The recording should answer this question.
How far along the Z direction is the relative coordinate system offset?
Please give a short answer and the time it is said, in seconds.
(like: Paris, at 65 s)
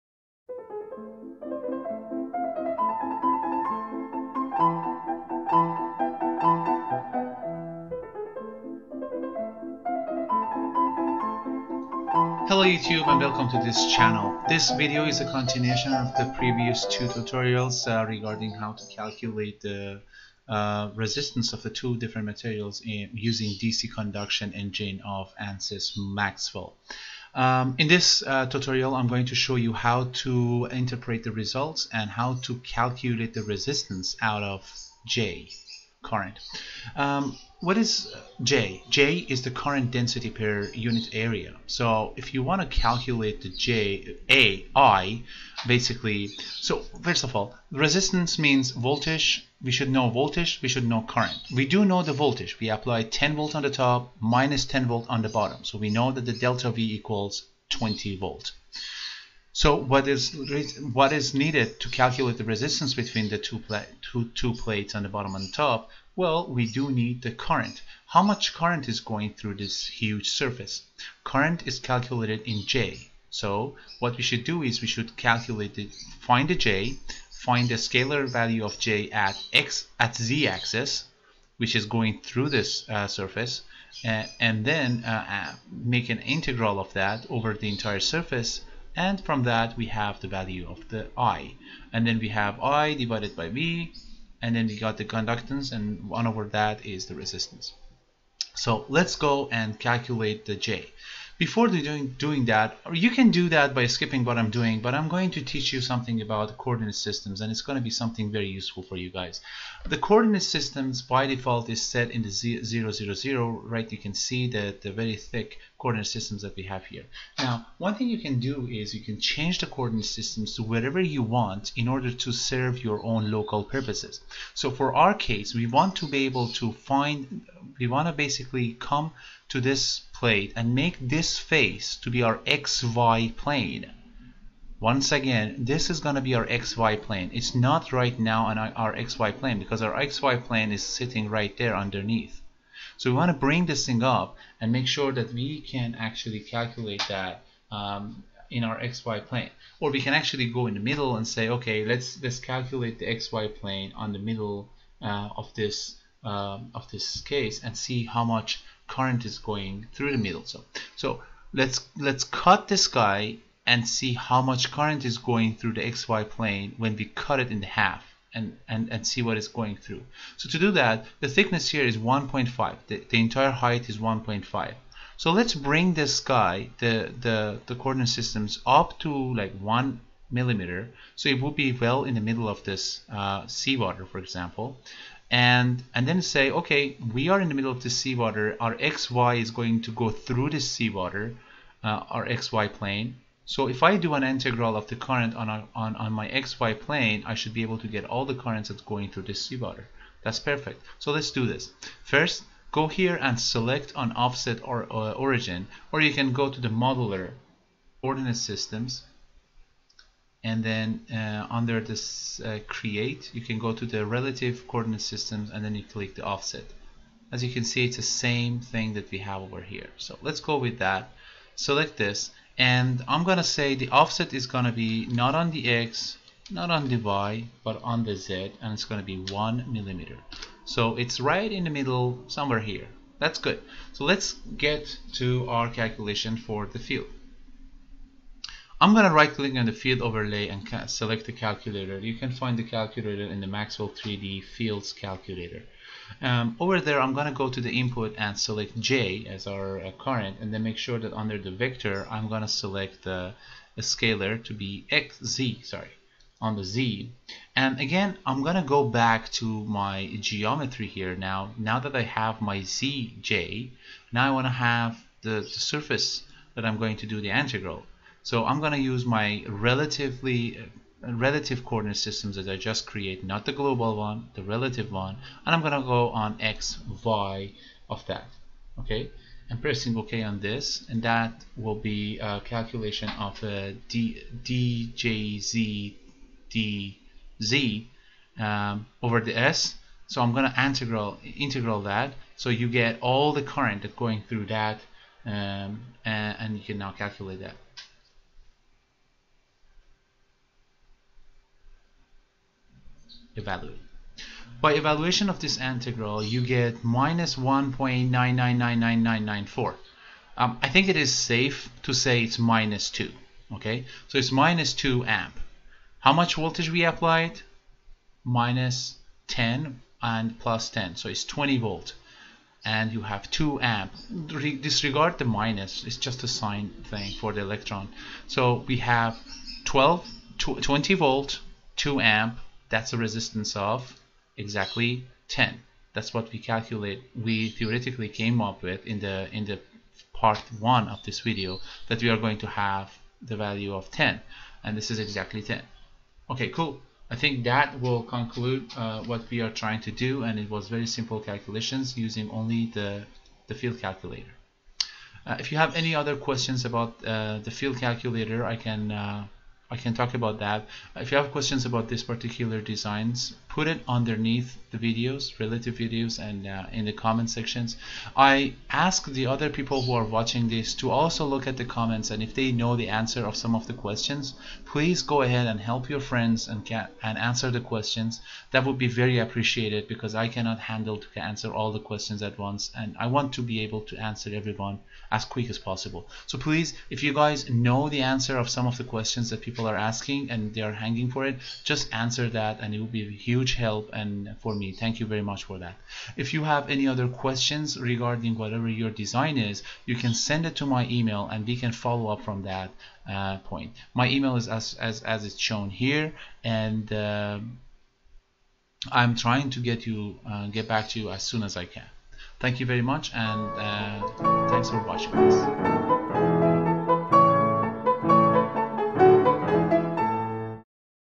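1 millimeter, at 229 s.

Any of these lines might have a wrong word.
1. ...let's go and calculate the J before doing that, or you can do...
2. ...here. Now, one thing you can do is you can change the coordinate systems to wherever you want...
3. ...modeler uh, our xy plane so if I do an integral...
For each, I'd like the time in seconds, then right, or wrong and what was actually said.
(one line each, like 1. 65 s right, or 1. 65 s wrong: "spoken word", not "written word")
1. 98 s right
2. 116 s right
3. 190 s wrong: "seawater", not "modeler".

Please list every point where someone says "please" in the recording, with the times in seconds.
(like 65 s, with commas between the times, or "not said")
374 s, 386 s.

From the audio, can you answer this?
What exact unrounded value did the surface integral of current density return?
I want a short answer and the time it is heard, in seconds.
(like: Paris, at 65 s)
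-1.9999994, at 306 s.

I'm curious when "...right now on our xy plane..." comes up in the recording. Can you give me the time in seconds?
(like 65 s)
137 s.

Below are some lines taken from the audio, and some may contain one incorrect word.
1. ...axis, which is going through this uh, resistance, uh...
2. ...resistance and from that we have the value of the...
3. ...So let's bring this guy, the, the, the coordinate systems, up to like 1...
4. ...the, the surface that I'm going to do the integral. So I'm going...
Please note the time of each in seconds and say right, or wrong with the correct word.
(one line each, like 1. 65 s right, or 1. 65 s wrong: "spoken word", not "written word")
1. 80 s wrong: "surface", not "resistance"
2. 87 s wrong: "surface", not "resistance"
3. 175 s right
4. 265 s right.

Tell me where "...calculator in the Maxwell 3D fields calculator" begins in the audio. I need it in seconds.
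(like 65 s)
242 s.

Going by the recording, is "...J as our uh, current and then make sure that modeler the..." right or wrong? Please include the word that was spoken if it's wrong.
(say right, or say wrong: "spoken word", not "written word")
wrong: "under", not "modeler".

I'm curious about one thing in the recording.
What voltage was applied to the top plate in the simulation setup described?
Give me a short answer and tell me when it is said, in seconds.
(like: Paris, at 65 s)
10 volt, at 53 s.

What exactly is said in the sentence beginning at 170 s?
So to do that, the thickness here is 1.5.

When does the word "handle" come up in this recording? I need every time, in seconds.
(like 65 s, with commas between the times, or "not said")
380 s.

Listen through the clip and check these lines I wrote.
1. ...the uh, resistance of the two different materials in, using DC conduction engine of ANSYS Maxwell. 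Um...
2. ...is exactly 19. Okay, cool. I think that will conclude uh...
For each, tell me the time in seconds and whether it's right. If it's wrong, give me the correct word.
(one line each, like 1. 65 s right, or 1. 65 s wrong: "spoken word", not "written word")
1. 19 s right
2. 344 s wrong: "10", not "19".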